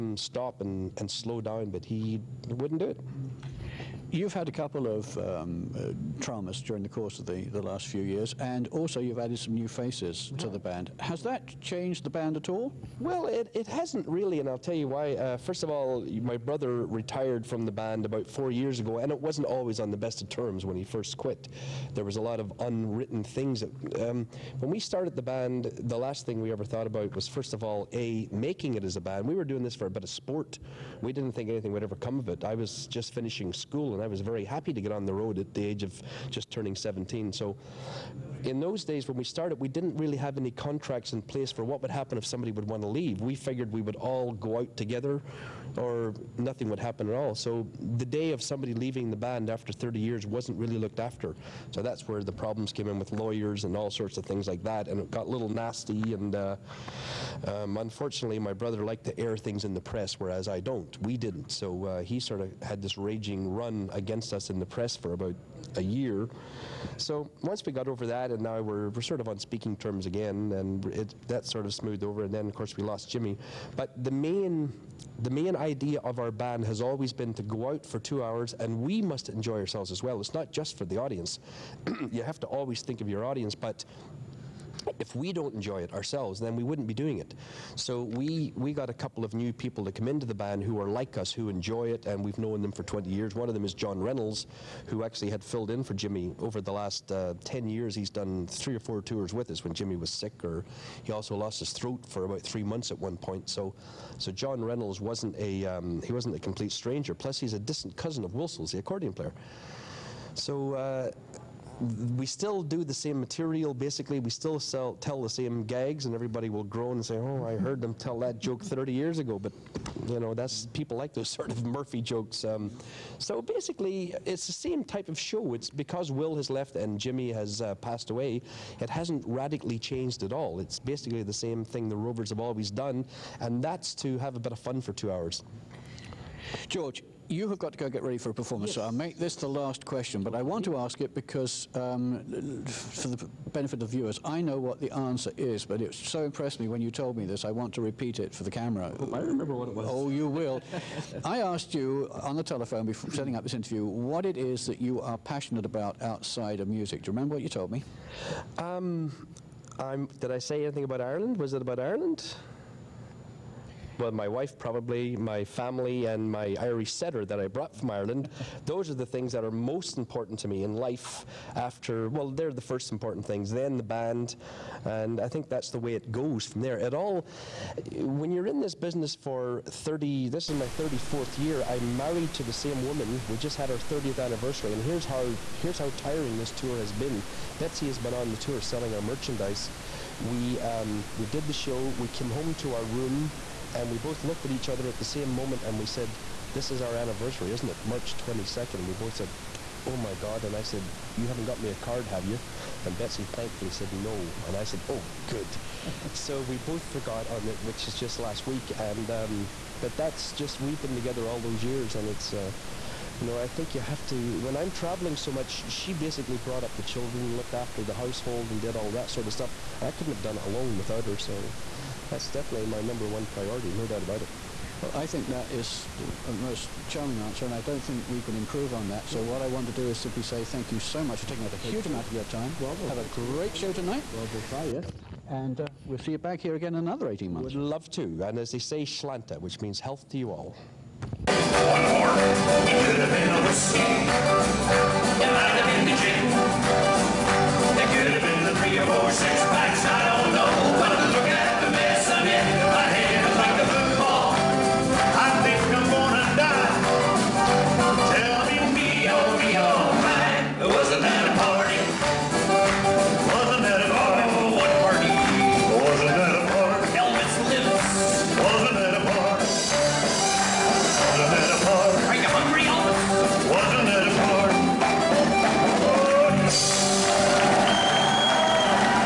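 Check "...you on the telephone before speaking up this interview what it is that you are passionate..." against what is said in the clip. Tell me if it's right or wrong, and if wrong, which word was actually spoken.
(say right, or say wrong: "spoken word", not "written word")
wrong: "setting", not "speaking".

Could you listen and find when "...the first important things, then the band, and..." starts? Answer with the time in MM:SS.
02:52.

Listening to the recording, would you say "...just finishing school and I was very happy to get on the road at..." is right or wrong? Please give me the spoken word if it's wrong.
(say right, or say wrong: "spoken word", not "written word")
right.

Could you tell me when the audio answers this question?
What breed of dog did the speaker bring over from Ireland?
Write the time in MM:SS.
02:46.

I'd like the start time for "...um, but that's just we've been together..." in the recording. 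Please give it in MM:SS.
03:29.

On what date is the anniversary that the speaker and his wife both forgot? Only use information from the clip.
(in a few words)
March 22nd.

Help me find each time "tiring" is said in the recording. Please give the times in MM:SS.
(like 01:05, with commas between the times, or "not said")
03:05.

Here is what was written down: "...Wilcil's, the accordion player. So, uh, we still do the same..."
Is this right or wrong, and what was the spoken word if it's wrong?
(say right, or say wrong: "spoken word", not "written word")
right.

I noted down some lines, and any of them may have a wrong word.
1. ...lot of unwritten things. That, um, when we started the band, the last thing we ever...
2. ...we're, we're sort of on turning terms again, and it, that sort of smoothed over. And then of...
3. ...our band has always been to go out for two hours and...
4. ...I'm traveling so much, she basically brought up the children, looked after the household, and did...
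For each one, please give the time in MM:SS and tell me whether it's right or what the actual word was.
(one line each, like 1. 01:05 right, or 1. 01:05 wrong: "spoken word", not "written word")
1. 00:22 right
2. 01:08 wrong: "speaking", not "turning"
3. 01:16 right
4. 03:34 right.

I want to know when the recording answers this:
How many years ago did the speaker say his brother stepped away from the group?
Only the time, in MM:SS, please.
00:18.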